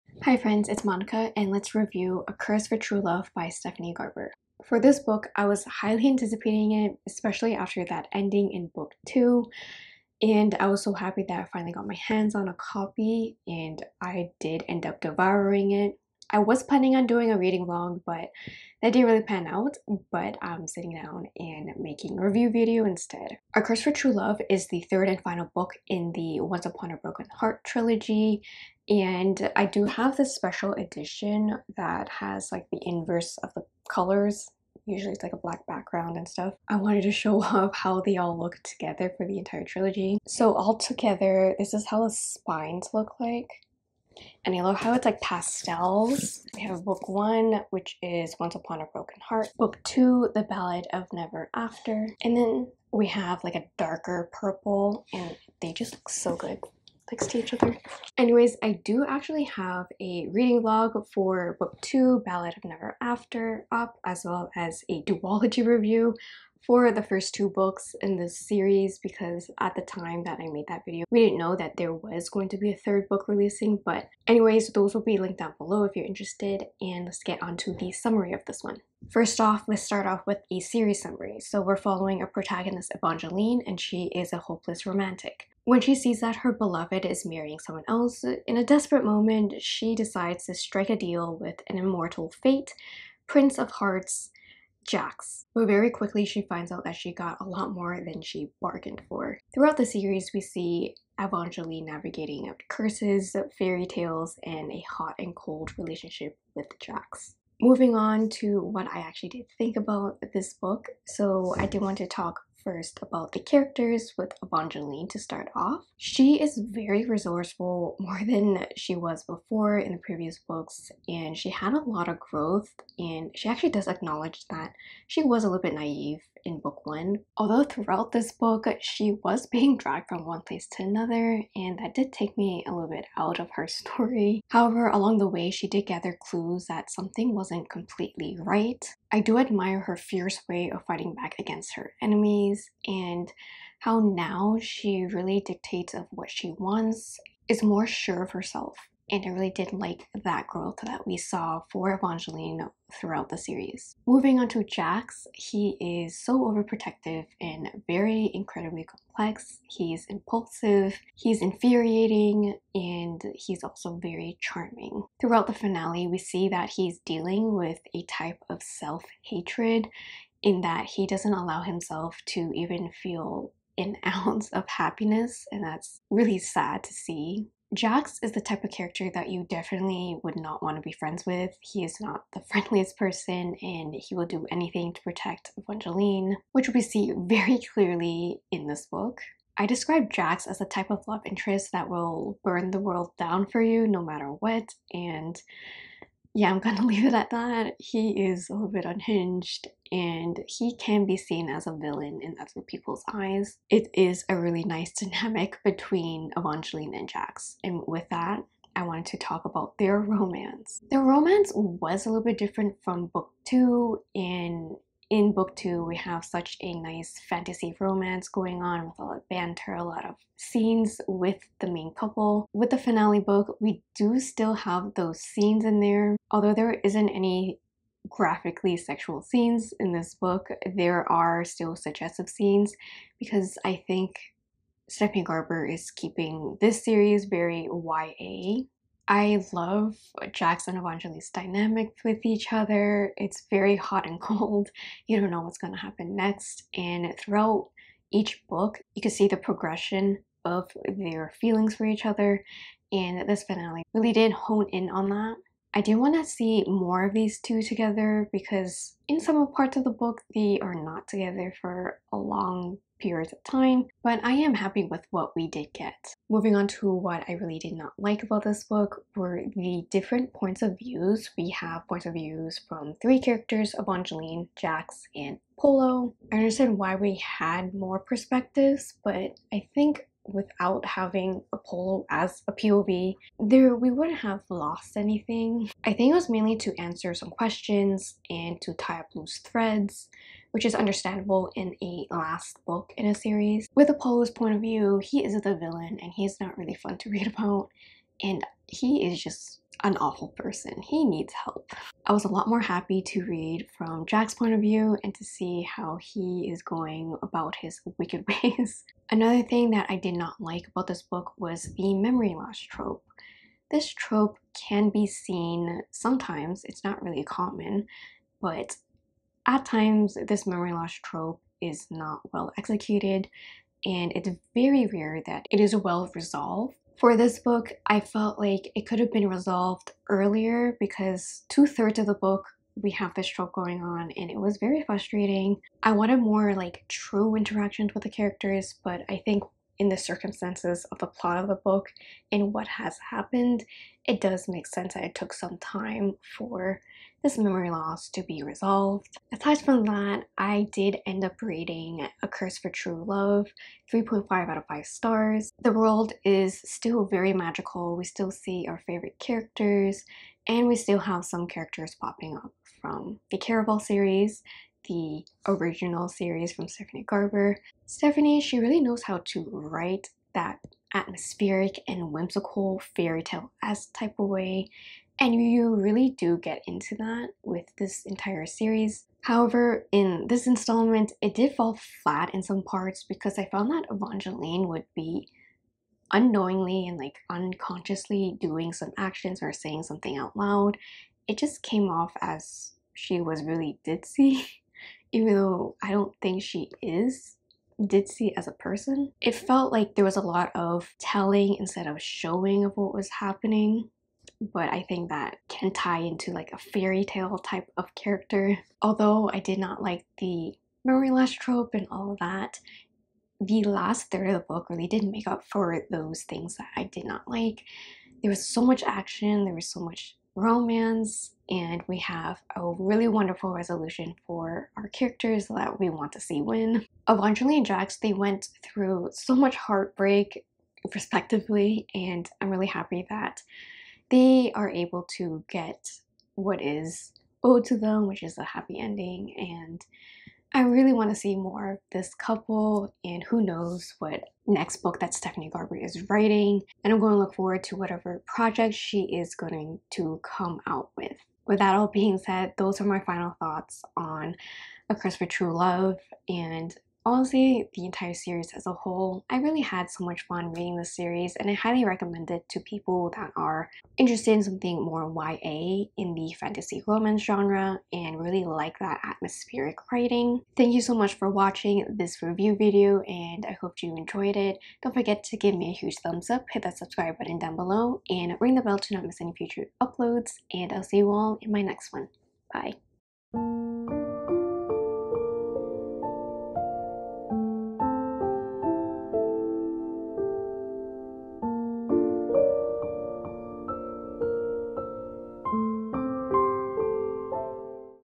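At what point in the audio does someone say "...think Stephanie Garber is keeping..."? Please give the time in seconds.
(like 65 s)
233 s.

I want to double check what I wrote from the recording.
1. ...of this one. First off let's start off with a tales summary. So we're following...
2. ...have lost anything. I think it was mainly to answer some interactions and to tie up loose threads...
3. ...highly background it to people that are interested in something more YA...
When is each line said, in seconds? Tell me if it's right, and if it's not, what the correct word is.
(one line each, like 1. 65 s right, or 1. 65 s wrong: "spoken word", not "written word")
1. 78 s wrong: "series", not "tales"
2. 284 s wrong: "questions", not "interactions"
3. 461 s wrong: "recommend", not "background".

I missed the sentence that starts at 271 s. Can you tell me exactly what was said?
We have points of views from three characters, Evangeline, Jacks, and Apollo.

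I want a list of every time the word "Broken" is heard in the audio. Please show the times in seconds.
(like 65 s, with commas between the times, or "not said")
26 s, 48 s.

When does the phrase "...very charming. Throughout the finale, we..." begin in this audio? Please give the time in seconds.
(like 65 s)
163 s.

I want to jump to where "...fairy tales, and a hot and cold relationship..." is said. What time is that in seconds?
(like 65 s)
103 s.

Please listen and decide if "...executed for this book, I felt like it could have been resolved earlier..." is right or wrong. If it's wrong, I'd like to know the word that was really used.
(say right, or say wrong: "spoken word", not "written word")
wrong: "resolved", not "executed".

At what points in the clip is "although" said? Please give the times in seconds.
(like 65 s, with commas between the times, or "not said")
127 s, 226 s, 408 s.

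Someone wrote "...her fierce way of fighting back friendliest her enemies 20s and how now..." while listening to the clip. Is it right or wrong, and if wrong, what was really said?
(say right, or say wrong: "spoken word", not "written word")
wrong: "against", not "friendliest".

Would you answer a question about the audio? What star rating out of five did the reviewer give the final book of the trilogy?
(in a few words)
3.5.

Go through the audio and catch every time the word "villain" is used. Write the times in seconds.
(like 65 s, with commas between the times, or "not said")
201 s, 295 s.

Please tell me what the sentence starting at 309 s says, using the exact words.
Another thing that I did not like about this book was the memory loss trope.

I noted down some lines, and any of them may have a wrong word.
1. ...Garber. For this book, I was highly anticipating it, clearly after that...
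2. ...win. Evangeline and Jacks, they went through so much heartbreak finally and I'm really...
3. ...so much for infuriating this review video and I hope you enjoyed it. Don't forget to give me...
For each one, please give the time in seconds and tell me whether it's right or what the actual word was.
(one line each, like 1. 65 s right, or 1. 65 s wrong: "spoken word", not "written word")
1. 3 s wrong: "especially", not "clearly"
2. 426 s wrong: "respectively", not "finally"
3. 470 s wrong: "watching", not "infuriating".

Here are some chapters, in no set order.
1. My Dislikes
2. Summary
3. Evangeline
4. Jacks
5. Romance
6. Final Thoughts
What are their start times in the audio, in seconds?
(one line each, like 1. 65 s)
1. 266 s
2. 74 s
3. 108 s
4. 153 s
5. 207 s
6. 350 s.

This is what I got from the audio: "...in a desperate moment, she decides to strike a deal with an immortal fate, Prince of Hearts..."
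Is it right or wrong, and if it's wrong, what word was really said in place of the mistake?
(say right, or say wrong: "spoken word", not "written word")
right.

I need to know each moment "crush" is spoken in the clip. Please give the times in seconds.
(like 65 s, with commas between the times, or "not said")
not said.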